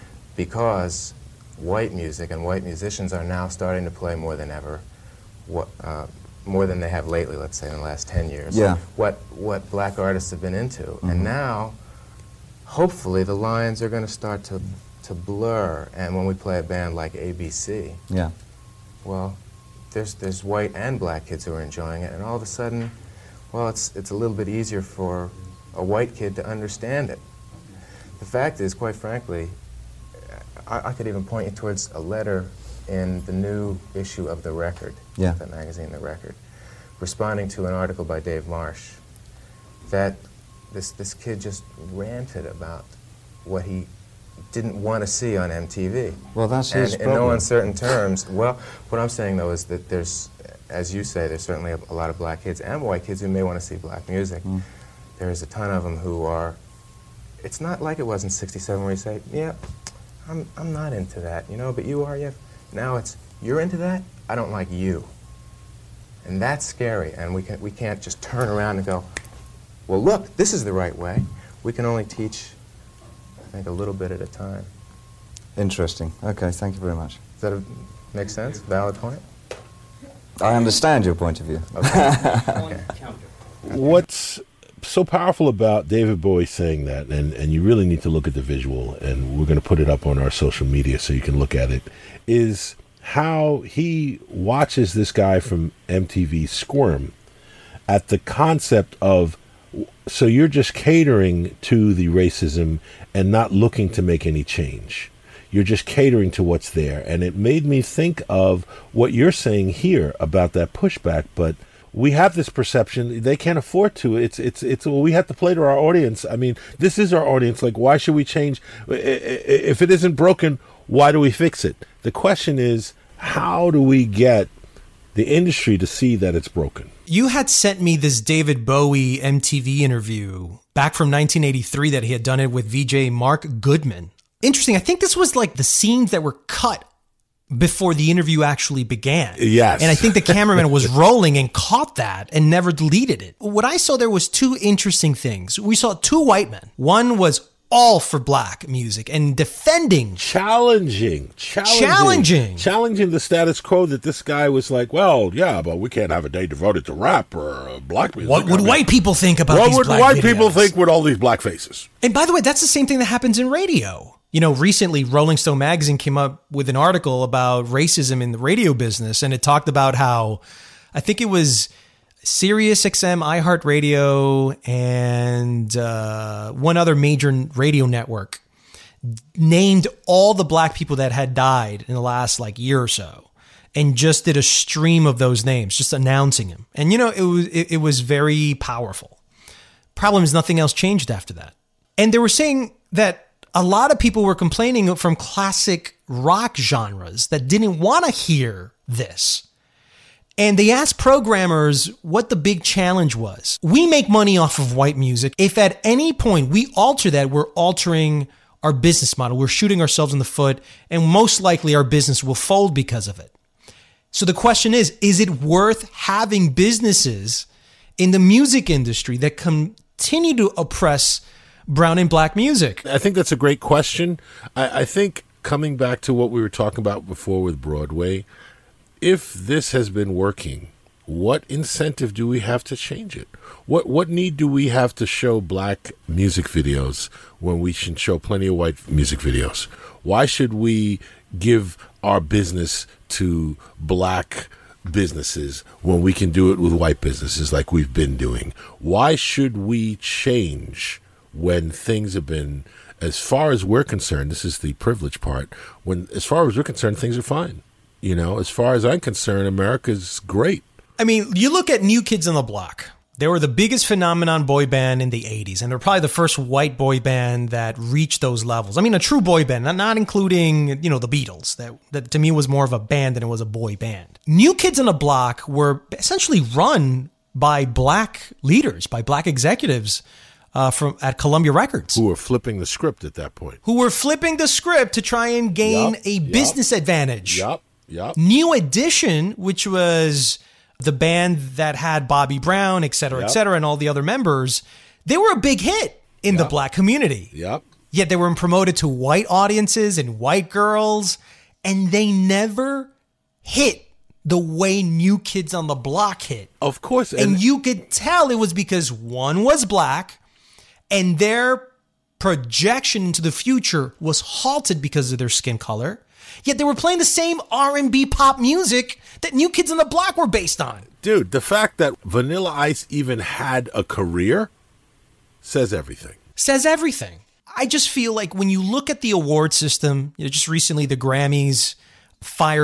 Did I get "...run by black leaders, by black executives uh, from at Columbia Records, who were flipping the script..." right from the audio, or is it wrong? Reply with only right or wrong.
right.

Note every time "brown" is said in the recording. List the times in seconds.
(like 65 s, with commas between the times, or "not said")
221 s, 292 s.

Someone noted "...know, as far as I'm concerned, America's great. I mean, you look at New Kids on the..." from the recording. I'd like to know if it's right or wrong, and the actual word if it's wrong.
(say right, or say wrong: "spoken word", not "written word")
right.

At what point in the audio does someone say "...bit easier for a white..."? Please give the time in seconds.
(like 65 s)
24 s.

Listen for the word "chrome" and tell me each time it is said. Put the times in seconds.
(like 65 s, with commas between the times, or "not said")
not said.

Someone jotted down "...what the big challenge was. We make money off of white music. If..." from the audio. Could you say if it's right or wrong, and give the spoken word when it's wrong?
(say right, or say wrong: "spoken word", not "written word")
right.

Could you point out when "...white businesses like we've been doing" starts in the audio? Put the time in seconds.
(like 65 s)
246 s.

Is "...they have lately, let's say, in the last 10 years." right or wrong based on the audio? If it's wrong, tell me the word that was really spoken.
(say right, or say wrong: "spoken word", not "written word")
right.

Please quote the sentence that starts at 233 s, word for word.
What what need do we have to show black music videos when we should show plenty of white music videos?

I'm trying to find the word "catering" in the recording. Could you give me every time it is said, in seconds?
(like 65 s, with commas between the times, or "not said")
100 s, 105 s.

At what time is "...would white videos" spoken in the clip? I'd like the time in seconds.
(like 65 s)
159 s.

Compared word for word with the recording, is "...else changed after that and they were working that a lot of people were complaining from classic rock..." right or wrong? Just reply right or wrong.
wrong.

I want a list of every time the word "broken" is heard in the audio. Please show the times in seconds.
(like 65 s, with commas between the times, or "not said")
120 s, 126 s.